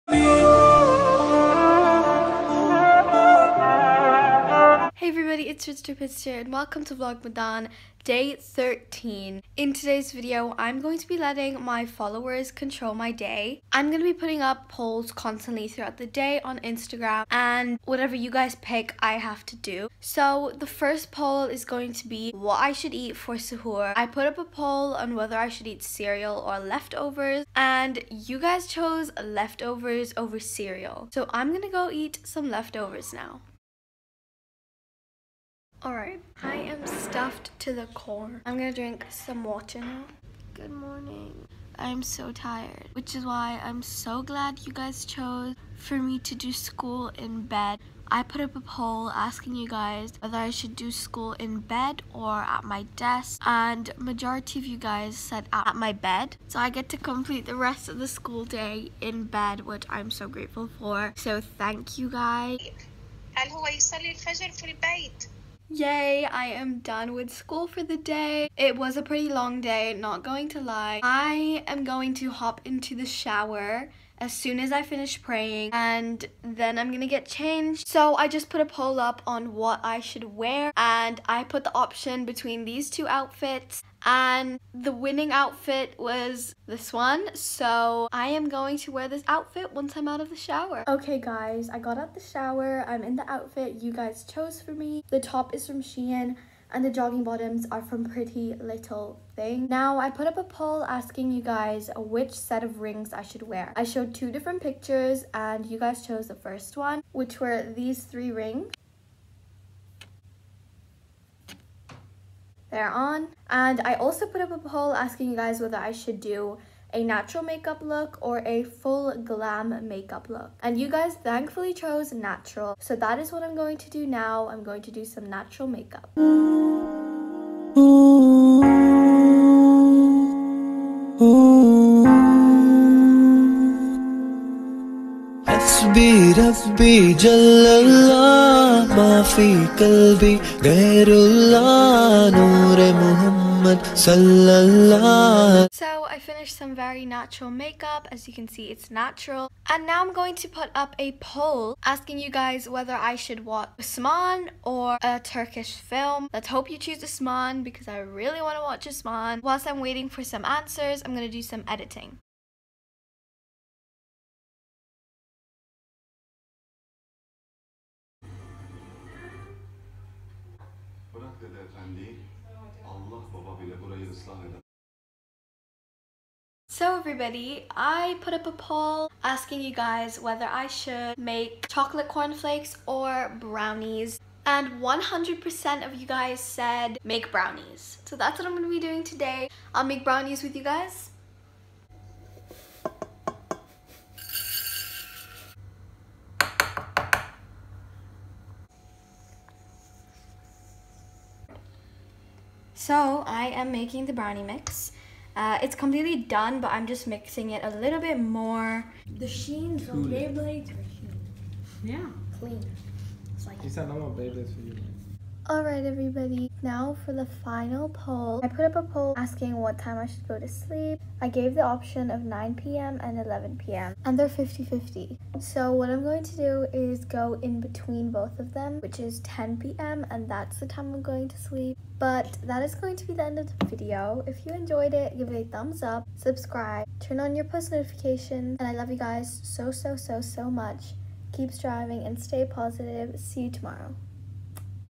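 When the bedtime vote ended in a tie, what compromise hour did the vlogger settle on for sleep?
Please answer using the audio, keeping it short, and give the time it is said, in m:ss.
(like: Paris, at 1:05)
10 p.m., at 3:49.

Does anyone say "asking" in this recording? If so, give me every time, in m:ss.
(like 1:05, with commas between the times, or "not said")
0:49, 1:40, 1:54, 2:31, 2:59, 3:39.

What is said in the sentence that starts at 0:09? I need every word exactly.
In today's video, I'm going to be letting my followers control my day.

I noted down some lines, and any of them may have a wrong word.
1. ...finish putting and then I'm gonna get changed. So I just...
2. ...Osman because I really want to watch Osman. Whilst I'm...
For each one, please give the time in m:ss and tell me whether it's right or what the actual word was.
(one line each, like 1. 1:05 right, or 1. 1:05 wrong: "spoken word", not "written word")
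1. 1:14 wrong: "praying", not "putting"
2. 2:37 right.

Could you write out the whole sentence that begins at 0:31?
So I'm going to go eat some leftovers now.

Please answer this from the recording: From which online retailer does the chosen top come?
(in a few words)
Shein.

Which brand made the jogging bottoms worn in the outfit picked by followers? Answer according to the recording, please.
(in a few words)
Pretty Little Thing.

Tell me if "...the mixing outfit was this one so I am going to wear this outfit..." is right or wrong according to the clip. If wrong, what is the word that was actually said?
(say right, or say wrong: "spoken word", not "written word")
wrong: "winning", not "mixing".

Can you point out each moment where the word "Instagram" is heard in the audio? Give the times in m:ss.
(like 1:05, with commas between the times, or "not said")
0:16.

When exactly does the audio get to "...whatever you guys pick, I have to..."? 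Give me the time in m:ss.
0:17.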